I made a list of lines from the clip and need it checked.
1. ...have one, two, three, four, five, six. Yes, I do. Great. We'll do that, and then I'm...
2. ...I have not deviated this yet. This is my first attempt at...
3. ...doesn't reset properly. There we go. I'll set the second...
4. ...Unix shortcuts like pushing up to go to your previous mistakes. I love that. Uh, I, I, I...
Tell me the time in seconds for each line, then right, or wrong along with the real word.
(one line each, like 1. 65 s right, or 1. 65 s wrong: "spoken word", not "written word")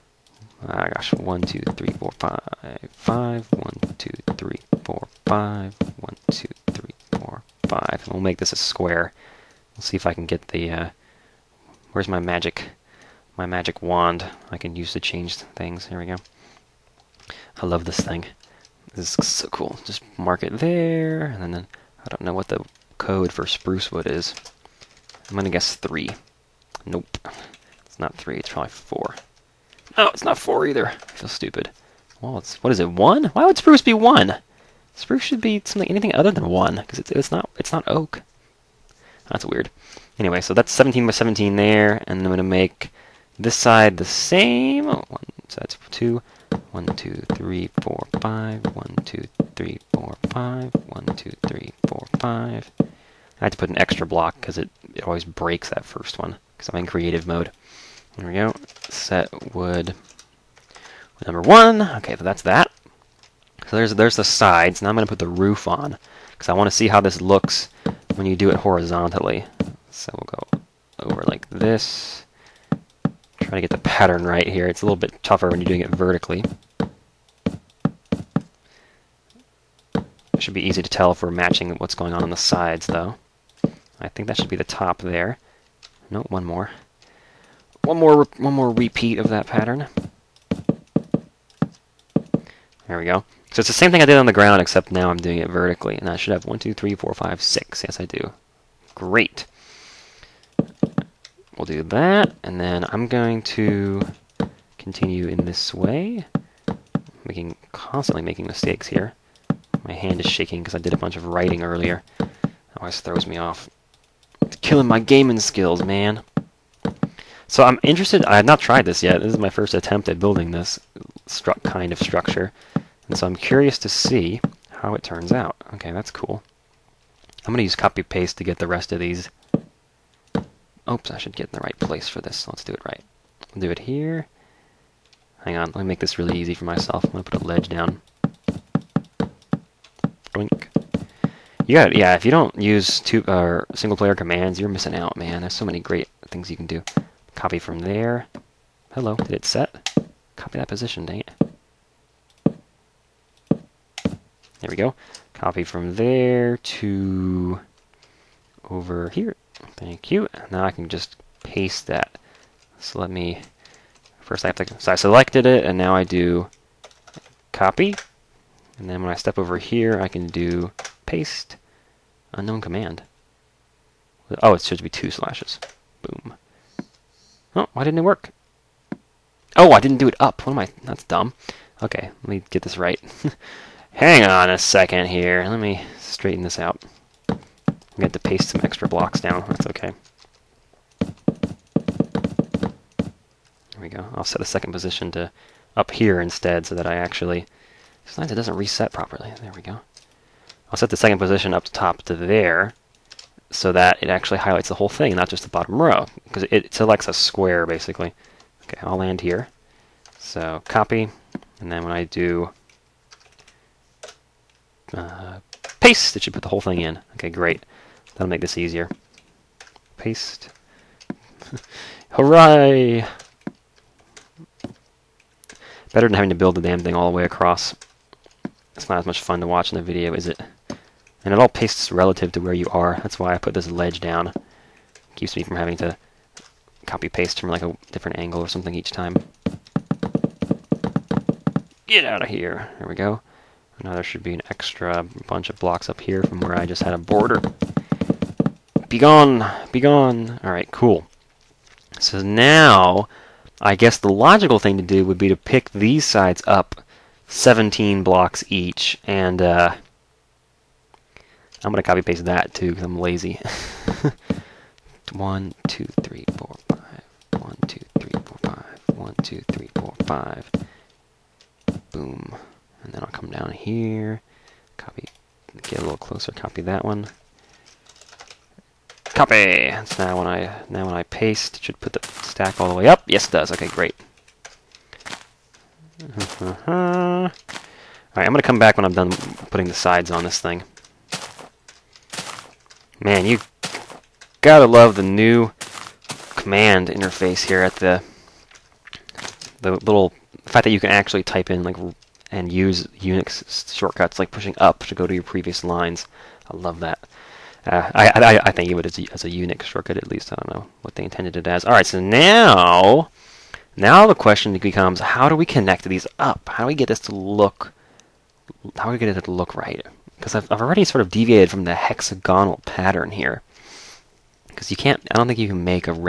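1. 96 s right
2. 118 s wrong: "tried", not "deviated"
3. 198 s right
4. 302 s wrong: "lines", not "mistakes".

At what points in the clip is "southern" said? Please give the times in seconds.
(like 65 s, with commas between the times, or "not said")
not said.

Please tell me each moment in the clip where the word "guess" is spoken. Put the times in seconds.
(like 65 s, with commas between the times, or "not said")
25 s, 253 s.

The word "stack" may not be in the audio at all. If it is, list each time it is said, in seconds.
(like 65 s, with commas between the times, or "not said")
282 s.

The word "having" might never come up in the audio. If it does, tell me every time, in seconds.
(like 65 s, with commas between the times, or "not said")
226 s, 235 s.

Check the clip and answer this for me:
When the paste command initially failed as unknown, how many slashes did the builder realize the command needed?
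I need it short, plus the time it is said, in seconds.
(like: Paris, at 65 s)
2, at 174 s.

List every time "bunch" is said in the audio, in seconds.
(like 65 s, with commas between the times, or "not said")
110 s, 245 s.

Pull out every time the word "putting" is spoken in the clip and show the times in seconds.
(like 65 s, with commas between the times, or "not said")
289 s.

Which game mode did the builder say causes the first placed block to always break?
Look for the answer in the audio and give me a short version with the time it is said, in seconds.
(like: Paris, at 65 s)
creative mode, at 56 s.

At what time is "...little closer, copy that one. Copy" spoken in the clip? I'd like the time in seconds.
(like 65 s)
275 s.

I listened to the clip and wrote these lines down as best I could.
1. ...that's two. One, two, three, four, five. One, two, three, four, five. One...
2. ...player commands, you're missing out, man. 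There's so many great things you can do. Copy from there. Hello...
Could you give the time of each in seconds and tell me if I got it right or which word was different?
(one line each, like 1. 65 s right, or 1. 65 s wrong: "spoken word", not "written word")
1. 45 s right
2. 143 s right.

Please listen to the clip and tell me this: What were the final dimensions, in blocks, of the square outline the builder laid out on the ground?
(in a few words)
17 by 17.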